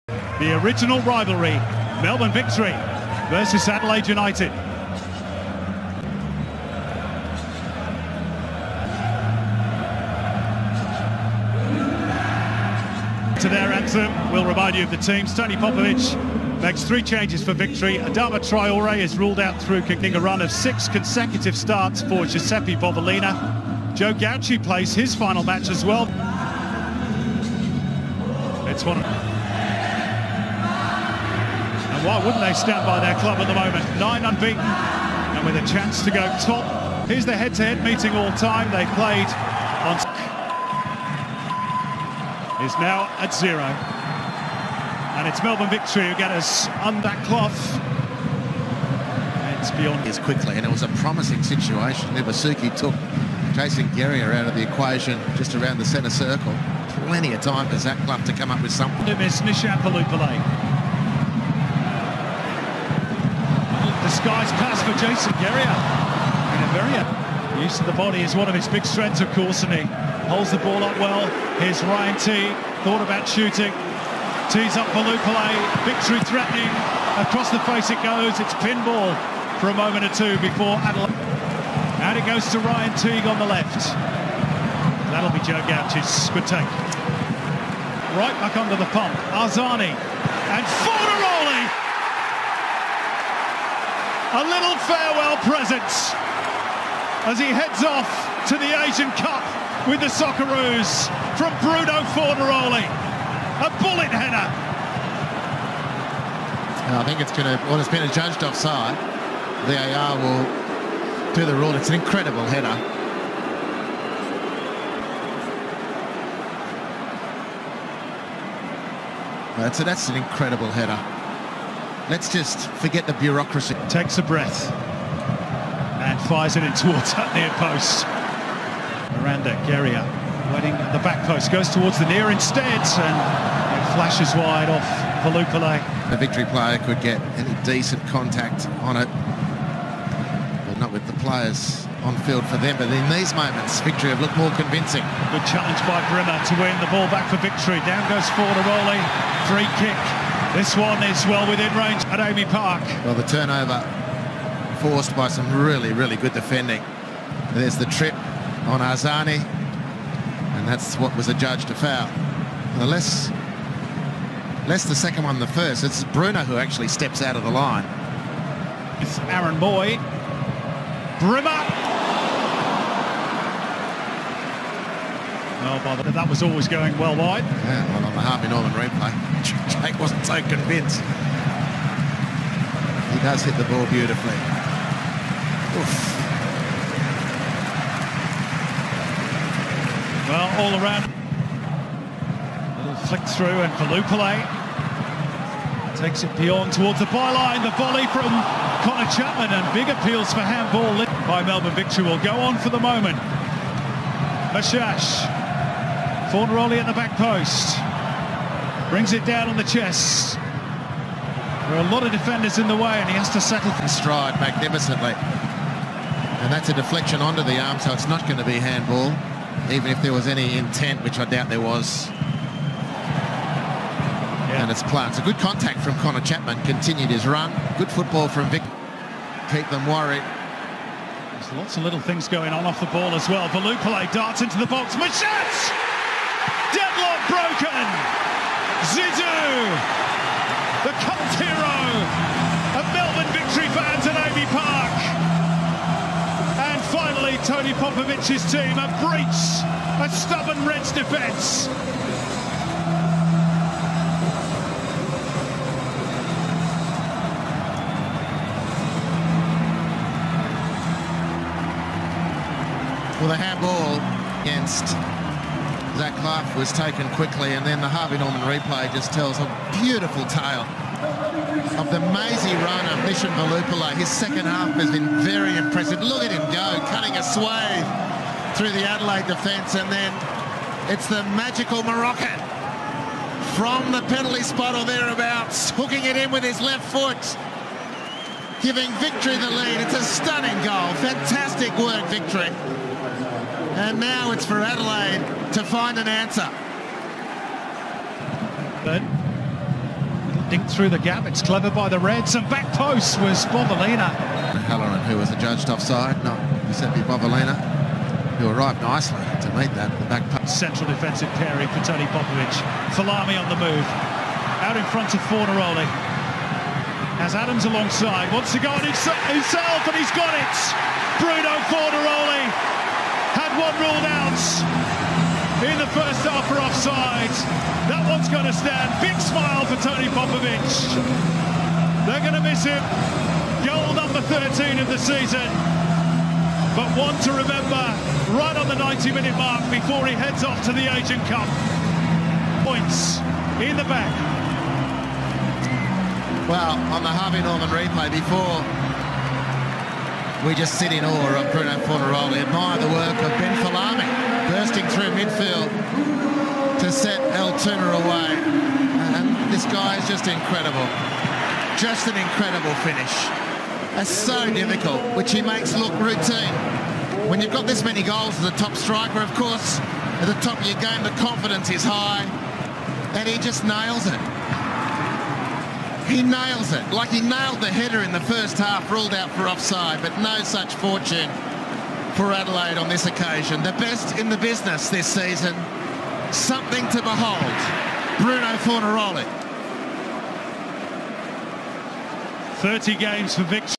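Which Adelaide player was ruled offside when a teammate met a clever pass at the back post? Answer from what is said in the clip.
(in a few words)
Halloran.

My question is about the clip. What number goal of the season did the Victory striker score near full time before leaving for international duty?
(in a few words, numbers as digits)
13.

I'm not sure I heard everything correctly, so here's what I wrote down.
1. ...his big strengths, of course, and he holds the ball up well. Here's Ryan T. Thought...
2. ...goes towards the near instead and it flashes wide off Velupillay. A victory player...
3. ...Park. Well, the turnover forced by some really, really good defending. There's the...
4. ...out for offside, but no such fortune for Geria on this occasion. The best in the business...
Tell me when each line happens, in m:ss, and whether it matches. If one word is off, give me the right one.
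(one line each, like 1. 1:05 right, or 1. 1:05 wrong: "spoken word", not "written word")
1. 1:08 right
2. 2:11 right
3. 2:32 right
4. 6:19 wrong: "Adelaide", not "Geria".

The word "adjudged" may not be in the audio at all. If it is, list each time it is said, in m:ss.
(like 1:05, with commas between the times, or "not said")
1:48, 2:41, 5:05.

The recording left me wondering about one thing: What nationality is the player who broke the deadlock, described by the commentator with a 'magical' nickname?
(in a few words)
Moroccan.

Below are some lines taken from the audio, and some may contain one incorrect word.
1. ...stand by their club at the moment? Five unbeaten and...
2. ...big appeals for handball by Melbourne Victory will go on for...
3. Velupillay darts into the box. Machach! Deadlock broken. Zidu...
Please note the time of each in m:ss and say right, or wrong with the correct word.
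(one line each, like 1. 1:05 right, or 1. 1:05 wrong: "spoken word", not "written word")
1. 0:32 wrong: "Nine", not "Five"
2. 3:19 right
3. 3:53 right.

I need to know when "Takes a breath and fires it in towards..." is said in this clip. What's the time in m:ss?
2:03.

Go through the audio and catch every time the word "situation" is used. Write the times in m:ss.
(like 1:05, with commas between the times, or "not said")
0:51.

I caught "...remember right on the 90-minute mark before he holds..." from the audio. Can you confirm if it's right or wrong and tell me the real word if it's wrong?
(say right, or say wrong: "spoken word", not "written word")
wrong: "heads", not "holds".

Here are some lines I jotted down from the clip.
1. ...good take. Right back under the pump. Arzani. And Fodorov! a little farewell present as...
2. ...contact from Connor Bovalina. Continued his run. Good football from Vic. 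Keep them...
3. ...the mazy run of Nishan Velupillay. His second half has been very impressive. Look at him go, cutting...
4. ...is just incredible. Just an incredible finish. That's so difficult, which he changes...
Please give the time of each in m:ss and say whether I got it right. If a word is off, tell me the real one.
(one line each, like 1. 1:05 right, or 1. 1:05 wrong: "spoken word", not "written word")
1. 1:26 right
2. 3:45 wrong: "Chapman", not "Bovalina"
3. 4:31 right
4. 5:59 wrong: "makes", not "changes".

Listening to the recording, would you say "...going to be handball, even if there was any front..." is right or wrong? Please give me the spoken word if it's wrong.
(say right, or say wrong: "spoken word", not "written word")
wrong: "intent", not "front".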